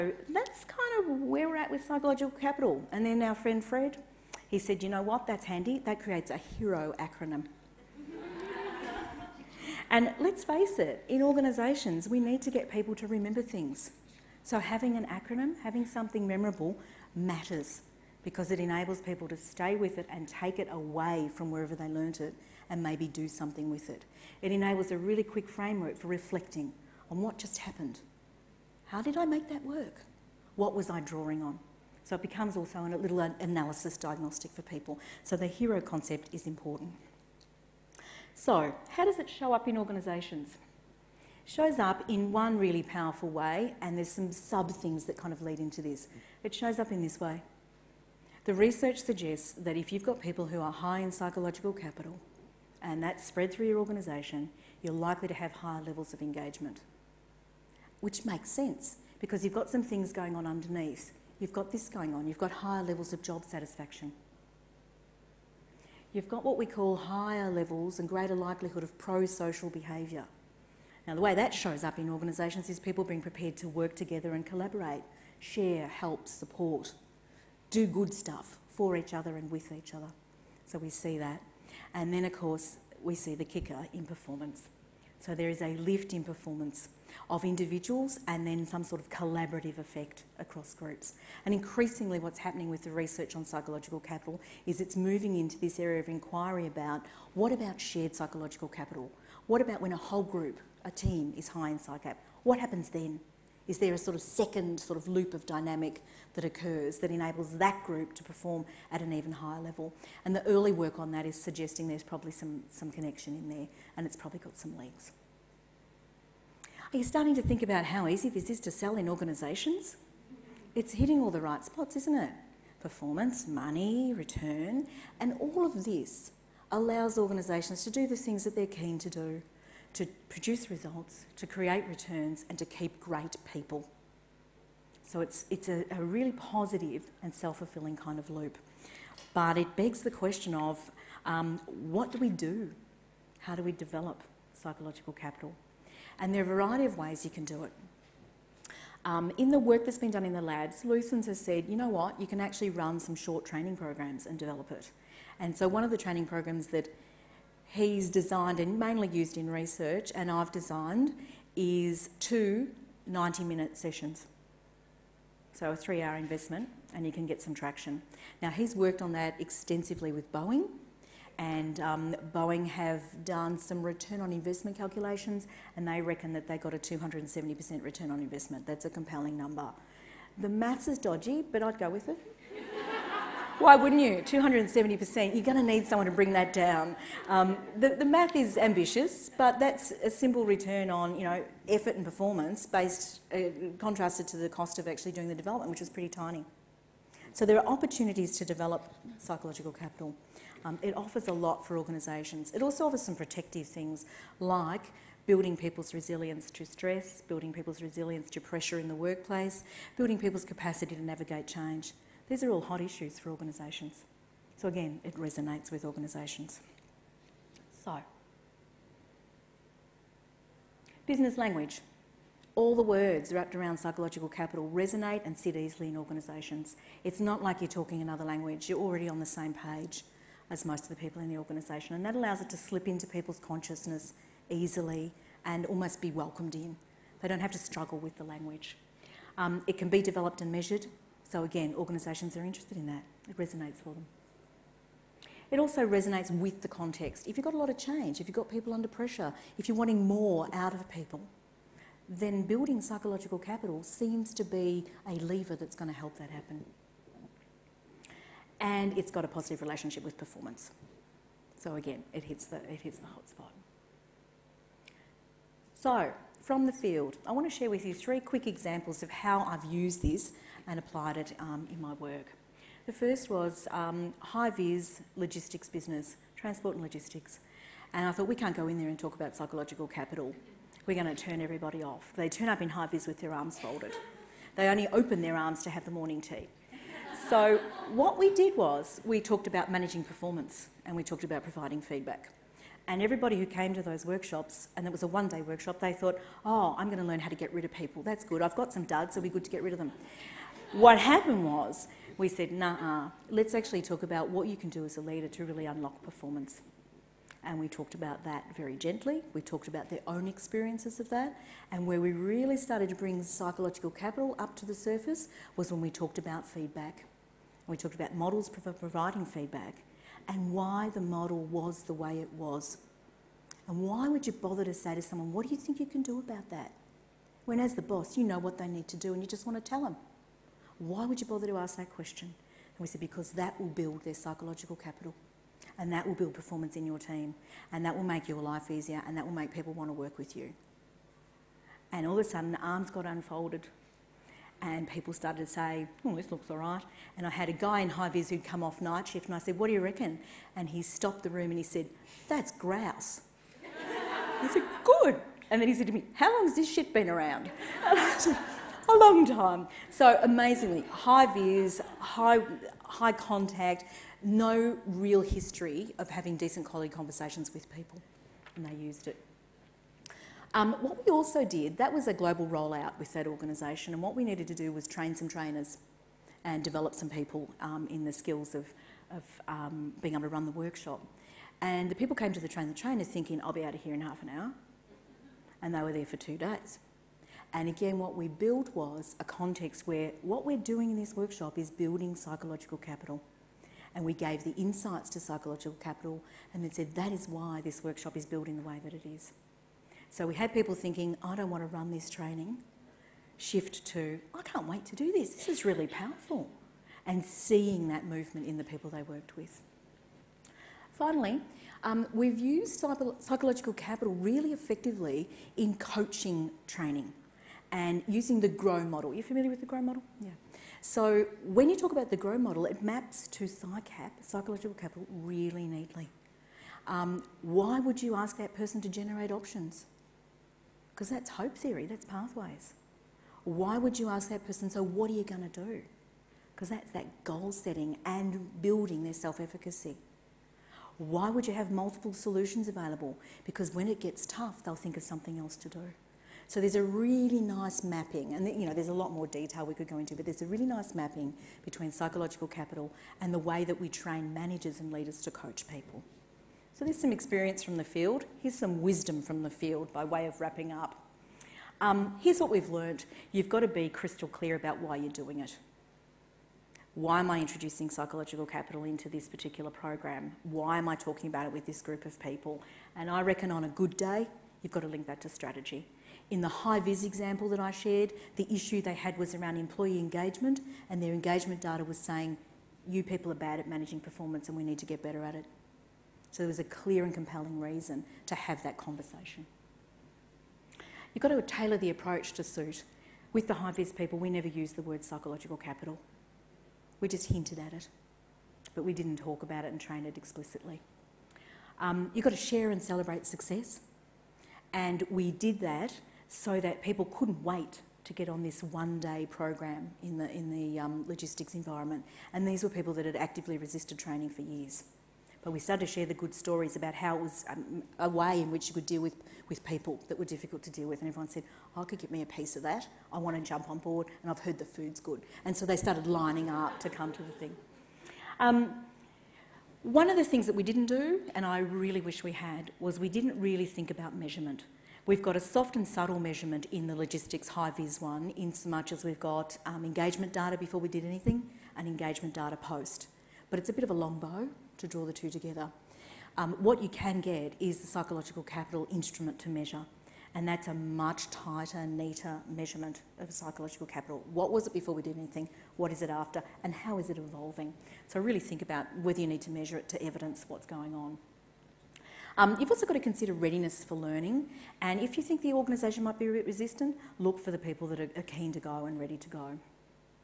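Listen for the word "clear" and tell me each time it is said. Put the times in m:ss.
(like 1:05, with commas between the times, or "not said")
7:44, 8:06.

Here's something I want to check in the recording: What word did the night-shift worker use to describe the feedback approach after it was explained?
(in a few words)
Grouse.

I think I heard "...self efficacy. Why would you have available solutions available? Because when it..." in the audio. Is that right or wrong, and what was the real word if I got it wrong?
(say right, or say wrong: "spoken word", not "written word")
wrong: "multiple", not "available".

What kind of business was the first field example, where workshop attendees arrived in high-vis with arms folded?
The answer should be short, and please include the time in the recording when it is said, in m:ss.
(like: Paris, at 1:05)
Transport and logistics, at 4:36.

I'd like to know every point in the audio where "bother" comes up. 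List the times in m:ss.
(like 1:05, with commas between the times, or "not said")
5:24, 5:31.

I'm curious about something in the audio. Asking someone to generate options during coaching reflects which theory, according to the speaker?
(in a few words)
Hope theory.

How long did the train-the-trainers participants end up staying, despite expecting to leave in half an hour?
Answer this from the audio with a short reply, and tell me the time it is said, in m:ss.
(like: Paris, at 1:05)
2 days, at 6:26.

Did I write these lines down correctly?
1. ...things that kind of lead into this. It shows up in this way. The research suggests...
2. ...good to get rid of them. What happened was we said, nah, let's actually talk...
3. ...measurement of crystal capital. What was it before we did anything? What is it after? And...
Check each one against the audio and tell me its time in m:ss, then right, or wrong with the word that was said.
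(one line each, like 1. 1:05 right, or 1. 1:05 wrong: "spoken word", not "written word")
1. 0:44 right
2. 4:59 right
3. 9:12 wrong: "psychological", not "crystal".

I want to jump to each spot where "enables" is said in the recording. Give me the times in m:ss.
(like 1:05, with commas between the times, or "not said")
0:18, 0:24, 1:47.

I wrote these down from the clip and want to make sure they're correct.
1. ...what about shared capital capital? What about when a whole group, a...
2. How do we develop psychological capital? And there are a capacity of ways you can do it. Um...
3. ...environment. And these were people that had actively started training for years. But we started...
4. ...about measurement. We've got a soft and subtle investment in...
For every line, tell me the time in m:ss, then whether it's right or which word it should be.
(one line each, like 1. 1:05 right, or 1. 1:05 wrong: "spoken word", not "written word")
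1. 1:37 wrong: "psychological", not "capital"
2. 2:23 wrong: "variety", not "capacity"
3. 8:31 wrong: "resisted", not "started"
4. 8:53 wrong: "measurement", not "investment".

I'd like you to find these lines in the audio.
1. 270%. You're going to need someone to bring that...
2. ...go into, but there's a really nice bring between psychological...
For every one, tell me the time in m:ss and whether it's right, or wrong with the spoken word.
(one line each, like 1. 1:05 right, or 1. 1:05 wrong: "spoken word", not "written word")
1. 3:04 right
2. 7:29 wrong: "mapping", not "bring".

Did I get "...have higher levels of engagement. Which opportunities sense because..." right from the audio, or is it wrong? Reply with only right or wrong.
wrong.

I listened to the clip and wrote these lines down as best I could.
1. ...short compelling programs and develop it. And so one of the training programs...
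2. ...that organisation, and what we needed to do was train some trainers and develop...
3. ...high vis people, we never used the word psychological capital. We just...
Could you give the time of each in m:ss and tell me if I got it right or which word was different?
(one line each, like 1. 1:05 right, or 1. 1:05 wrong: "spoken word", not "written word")
1. 2:33 wrong: "training", not "compelling"
2. 6:13 right
3. 8:13 right.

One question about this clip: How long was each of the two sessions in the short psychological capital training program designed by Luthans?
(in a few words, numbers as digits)
90 minutes.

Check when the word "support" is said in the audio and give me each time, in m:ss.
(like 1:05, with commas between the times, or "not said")
1:16.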